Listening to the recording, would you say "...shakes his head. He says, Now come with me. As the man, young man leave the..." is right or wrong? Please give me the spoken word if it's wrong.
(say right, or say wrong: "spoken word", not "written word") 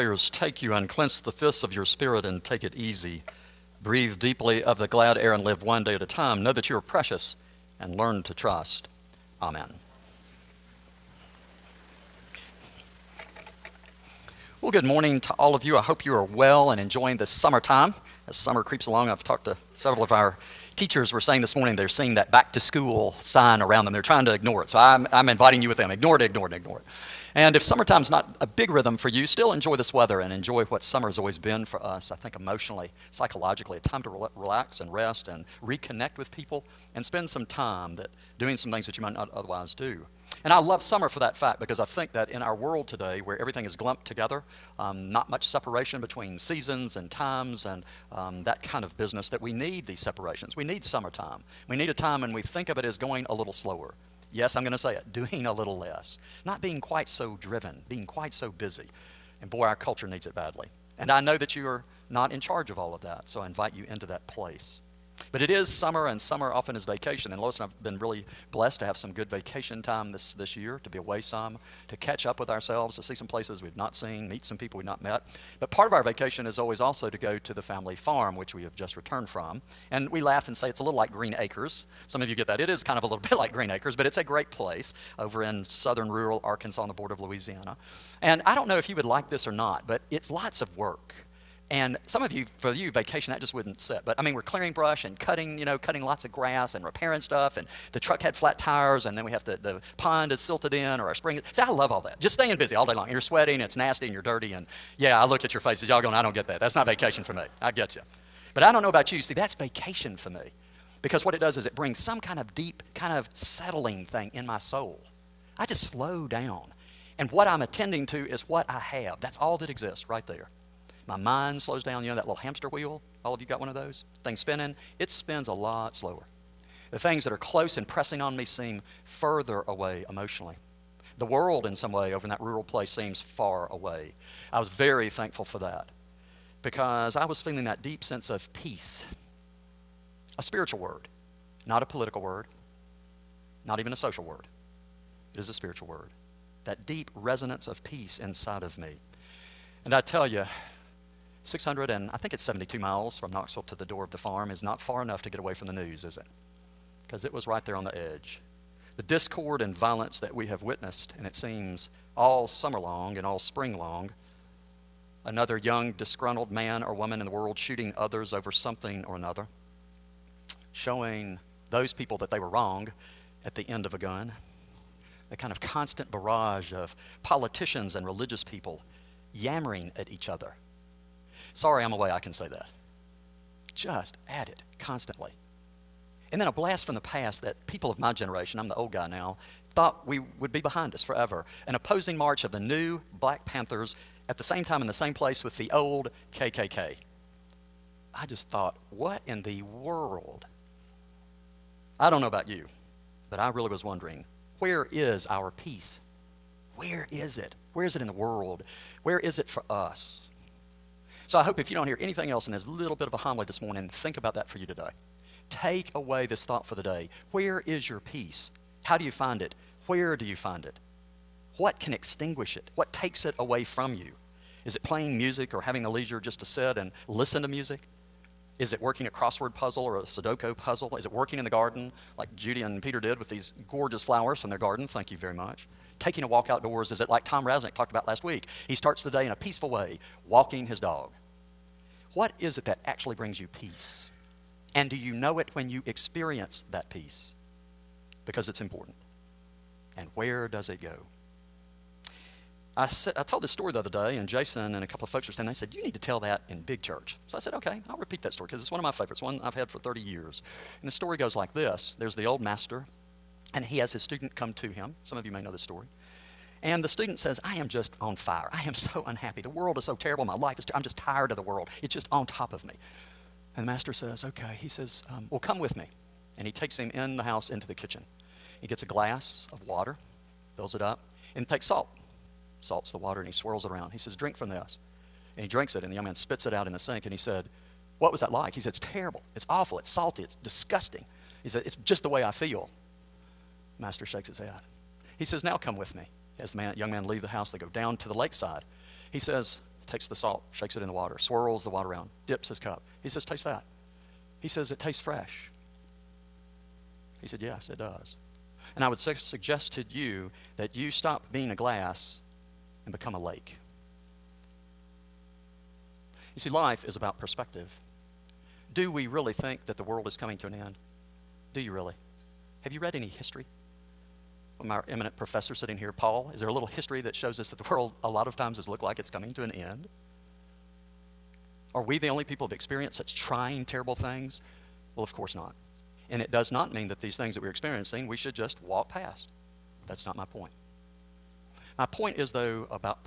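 right.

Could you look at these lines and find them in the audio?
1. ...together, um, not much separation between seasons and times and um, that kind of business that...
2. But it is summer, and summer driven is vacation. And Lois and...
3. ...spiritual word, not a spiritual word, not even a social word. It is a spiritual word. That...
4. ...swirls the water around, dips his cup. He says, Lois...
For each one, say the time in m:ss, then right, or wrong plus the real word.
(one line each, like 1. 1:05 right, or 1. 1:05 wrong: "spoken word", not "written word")
1. 0:44 right
2. 1:05 wrong: "often", not "driven"
3. 2:20 wrong: "political", not "spiritual"
4. 5:01 wrong: "Taste", not "Lois".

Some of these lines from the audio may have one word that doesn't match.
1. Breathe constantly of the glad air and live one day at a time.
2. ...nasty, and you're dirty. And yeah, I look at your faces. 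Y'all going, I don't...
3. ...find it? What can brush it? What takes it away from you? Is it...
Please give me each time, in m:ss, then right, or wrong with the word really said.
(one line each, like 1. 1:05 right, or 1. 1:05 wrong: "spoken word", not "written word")
1. 0:03 wrong: "deeply", not "constantly"
2. 1:43 right
3. 3:40 wrong: "extinguish", not "brush".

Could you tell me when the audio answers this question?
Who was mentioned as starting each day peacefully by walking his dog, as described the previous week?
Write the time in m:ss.
3:57.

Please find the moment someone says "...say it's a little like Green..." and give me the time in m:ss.
1:20.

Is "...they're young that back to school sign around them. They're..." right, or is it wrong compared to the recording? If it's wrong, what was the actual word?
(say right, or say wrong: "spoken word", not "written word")
wrong: "seeing", not "young".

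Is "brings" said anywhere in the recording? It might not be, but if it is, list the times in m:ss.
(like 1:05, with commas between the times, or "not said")
1:51, 4:03.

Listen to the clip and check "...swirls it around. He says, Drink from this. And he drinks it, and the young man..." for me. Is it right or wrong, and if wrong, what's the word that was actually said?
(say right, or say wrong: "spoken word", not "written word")
right.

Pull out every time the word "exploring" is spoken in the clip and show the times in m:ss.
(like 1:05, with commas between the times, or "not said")
not said.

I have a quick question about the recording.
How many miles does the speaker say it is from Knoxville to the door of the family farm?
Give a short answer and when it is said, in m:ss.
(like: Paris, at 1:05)
672, at 2:31.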